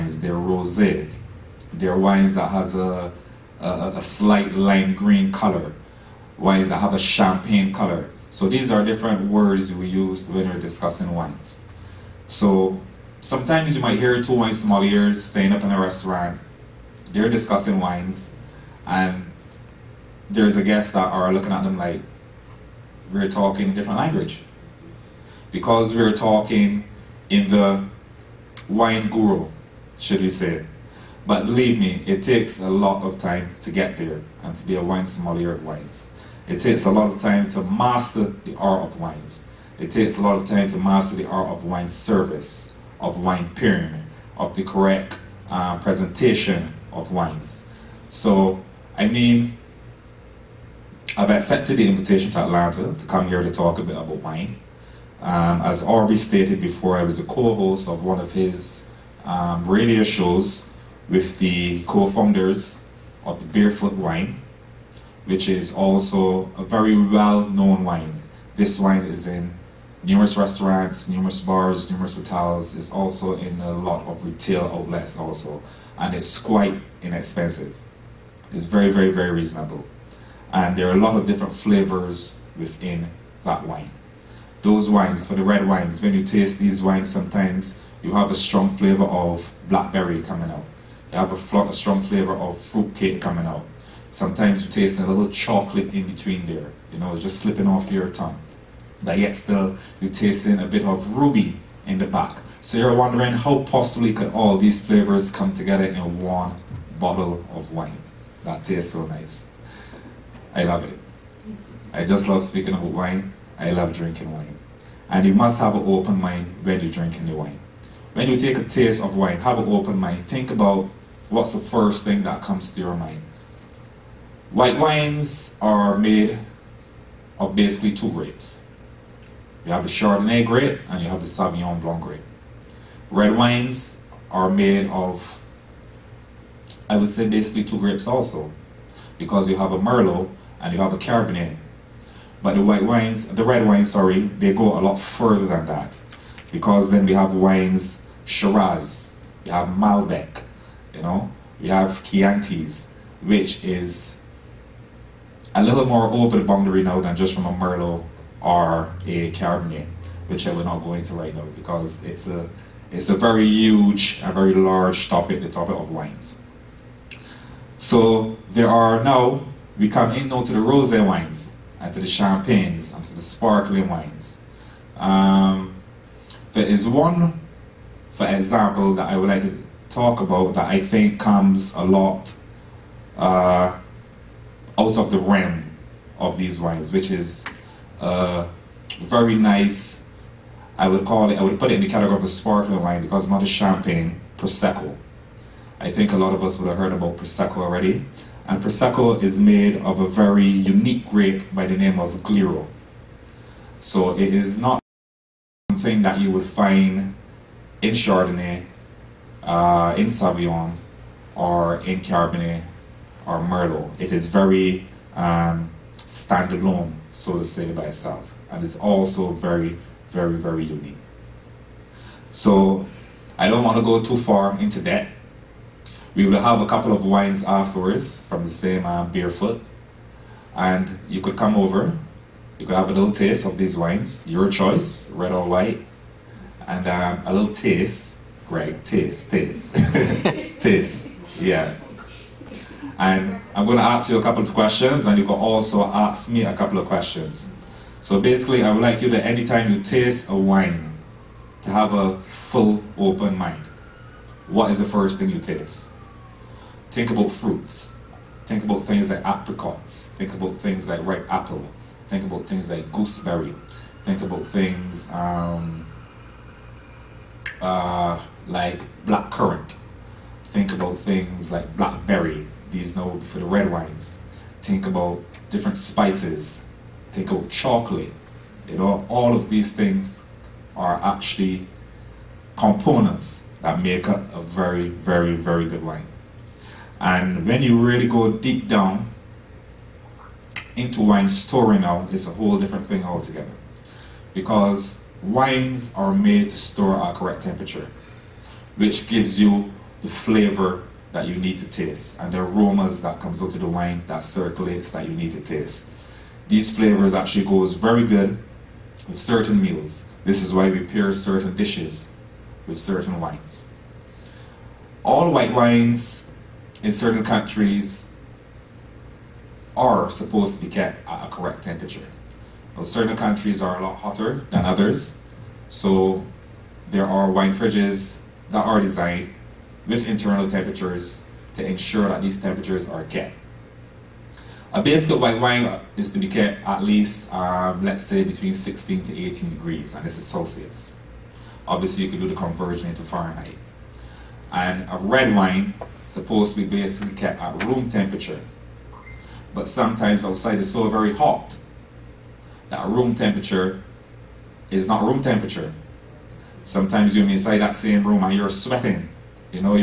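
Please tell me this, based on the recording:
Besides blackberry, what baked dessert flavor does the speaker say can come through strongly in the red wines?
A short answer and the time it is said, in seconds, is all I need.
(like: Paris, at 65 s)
Fruitcake, at 92 s.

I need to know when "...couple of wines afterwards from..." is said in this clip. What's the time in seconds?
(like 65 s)
226 s.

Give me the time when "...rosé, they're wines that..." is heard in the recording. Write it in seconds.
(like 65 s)
0 s.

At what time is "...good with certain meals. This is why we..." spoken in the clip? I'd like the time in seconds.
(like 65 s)
308 s.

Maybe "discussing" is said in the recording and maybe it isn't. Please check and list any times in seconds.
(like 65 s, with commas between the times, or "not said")
10 s, 17 s.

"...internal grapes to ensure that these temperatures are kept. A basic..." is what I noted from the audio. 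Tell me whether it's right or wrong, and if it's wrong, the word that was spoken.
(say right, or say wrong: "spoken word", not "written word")
wrong: "temperatures", not "grapes".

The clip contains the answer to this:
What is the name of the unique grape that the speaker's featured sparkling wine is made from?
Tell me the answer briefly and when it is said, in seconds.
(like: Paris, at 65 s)
Glera, at 202 s.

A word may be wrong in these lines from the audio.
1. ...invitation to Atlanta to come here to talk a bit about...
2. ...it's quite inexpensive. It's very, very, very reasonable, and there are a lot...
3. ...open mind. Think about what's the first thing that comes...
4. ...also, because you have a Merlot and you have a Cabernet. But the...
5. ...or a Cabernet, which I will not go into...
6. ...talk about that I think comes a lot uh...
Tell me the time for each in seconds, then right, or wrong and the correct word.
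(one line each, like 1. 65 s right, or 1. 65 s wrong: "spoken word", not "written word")
1. 51 s right
2. 76 s right
3. 119 s right
4. 138 s right
5. 158 s right
6. 179 s right.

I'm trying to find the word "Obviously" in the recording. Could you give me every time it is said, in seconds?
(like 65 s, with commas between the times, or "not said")
341 s.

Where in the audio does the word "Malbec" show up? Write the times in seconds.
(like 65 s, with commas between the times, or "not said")
149 s.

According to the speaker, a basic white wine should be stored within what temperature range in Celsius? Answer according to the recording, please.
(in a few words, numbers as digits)
16 to 18 degrees.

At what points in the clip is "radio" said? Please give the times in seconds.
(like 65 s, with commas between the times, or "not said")
59 s.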